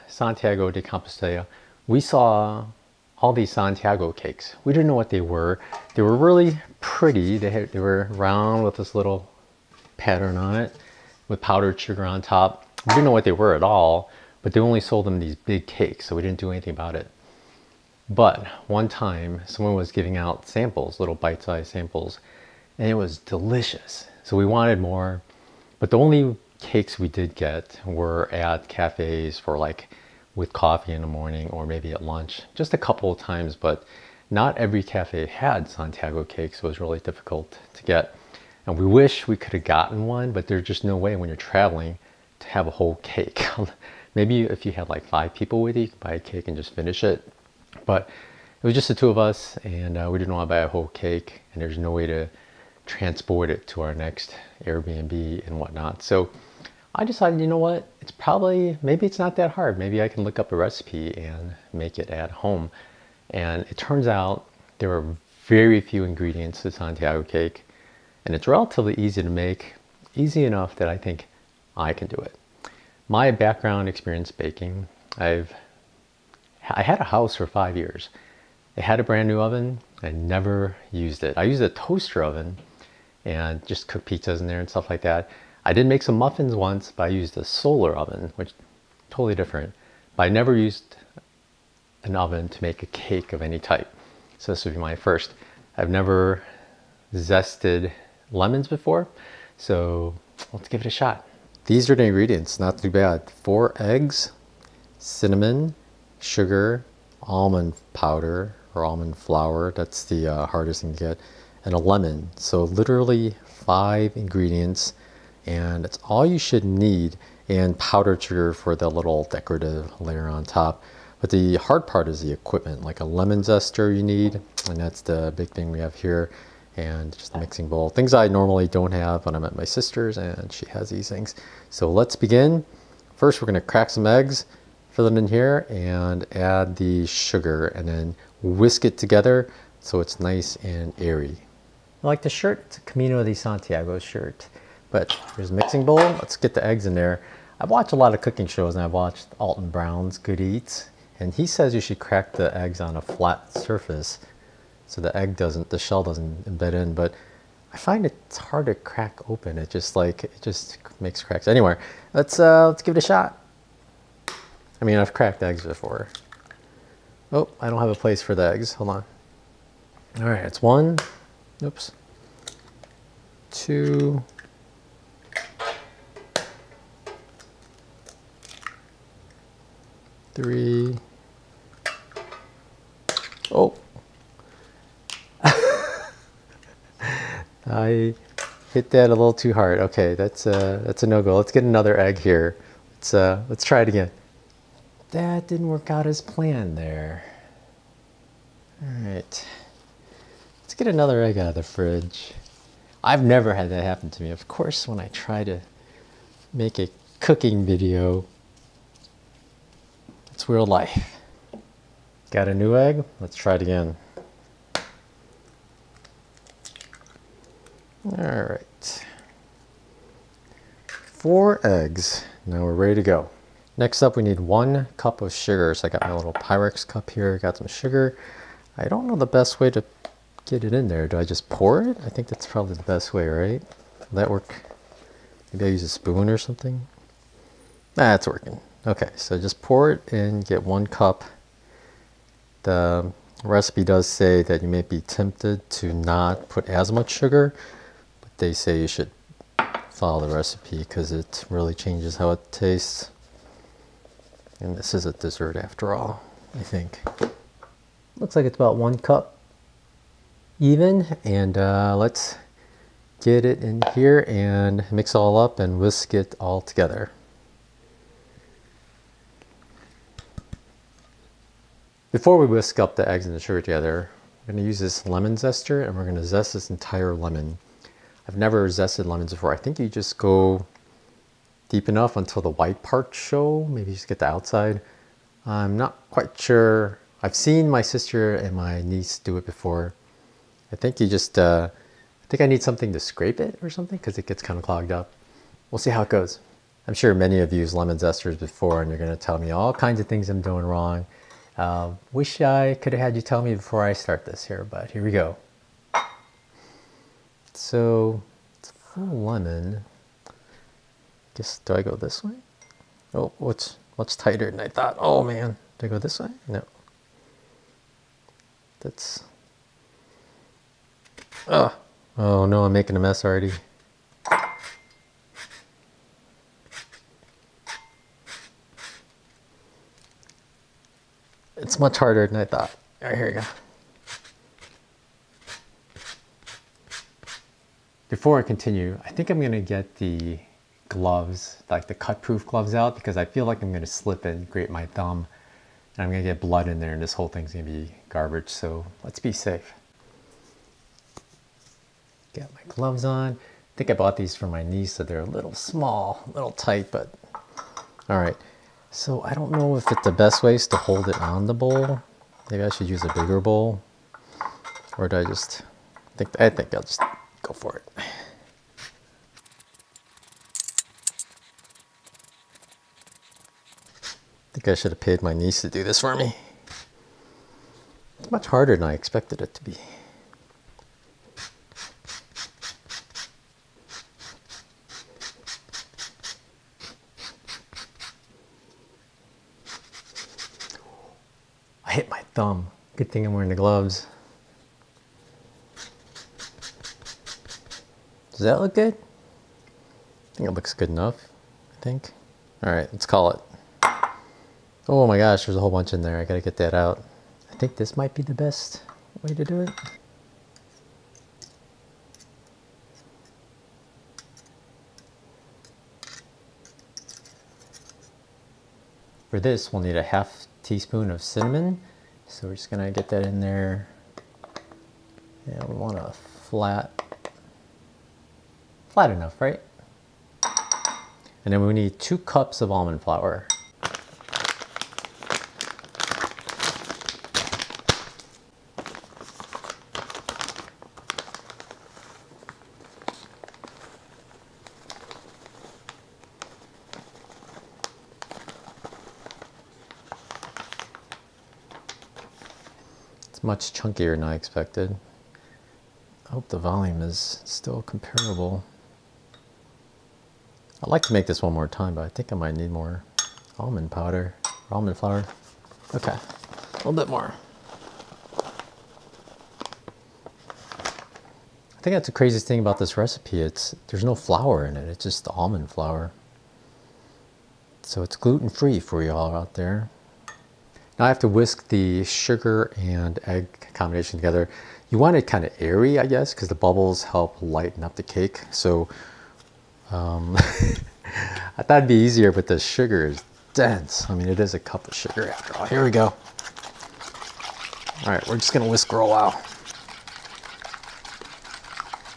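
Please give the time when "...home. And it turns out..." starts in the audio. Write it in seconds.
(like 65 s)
62 s.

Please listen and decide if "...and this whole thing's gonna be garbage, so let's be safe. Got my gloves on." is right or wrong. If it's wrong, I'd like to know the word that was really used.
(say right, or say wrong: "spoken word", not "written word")
right.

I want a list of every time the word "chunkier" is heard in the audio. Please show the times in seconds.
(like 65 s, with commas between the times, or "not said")
453 s.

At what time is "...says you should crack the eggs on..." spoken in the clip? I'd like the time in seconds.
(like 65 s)
151 s.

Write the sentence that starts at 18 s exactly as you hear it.
But one time, someone was giving out samples, little bite-sized samples, and it was delicious.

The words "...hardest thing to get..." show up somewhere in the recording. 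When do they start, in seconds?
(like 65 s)
110 s.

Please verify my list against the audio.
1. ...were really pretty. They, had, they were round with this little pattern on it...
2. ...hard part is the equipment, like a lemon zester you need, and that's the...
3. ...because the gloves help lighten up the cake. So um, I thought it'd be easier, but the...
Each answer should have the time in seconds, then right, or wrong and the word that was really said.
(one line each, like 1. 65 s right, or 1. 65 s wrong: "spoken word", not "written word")
1. 6 s right
2. 121 s right
3. 486 s wrong: "bubbles", not "gloves".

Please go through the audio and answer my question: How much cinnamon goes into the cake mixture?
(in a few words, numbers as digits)
half teaspoon.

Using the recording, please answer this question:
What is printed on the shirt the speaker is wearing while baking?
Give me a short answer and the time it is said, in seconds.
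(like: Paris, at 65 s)
Camino de Santiago, at 142 s.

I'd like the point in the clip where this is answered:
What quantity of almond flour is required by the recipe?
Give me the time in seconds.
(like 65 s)
431 s.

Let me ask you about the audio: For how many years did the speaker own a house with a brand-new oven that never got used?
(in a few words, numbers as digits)
5.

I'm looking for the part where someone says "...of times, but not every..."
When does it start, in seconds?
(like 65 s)
33 s.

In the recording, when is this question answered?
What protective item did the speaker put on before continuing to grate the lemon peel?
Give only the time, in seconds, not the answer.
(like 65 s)
341 s.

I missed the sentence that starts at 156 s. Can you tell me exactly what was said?
But I find it's hard to crack open.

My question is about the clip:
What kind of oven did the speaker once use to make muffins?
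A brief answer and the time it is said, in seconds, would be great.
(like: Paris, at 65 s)
solar oven, at 87 s.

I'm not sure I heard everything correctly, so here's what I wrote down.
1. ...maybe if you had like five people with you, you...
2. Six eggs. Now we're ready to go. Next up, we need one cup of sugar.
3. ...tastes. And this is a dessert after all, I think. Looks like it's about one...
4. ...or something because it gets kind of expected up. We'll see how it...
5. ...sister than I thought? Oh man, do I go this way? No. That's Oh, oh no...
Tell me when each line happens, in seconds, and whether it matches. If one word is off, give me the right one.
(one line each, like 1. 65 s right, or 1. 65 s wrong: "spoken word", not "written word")
1. 44 s right
2. 220 s wrong: "Four", not "Six"
3. 252 s right
4. 293 s wrong: "clogged", not "expected"
5. 314 s wrong: "tighter", not "sister".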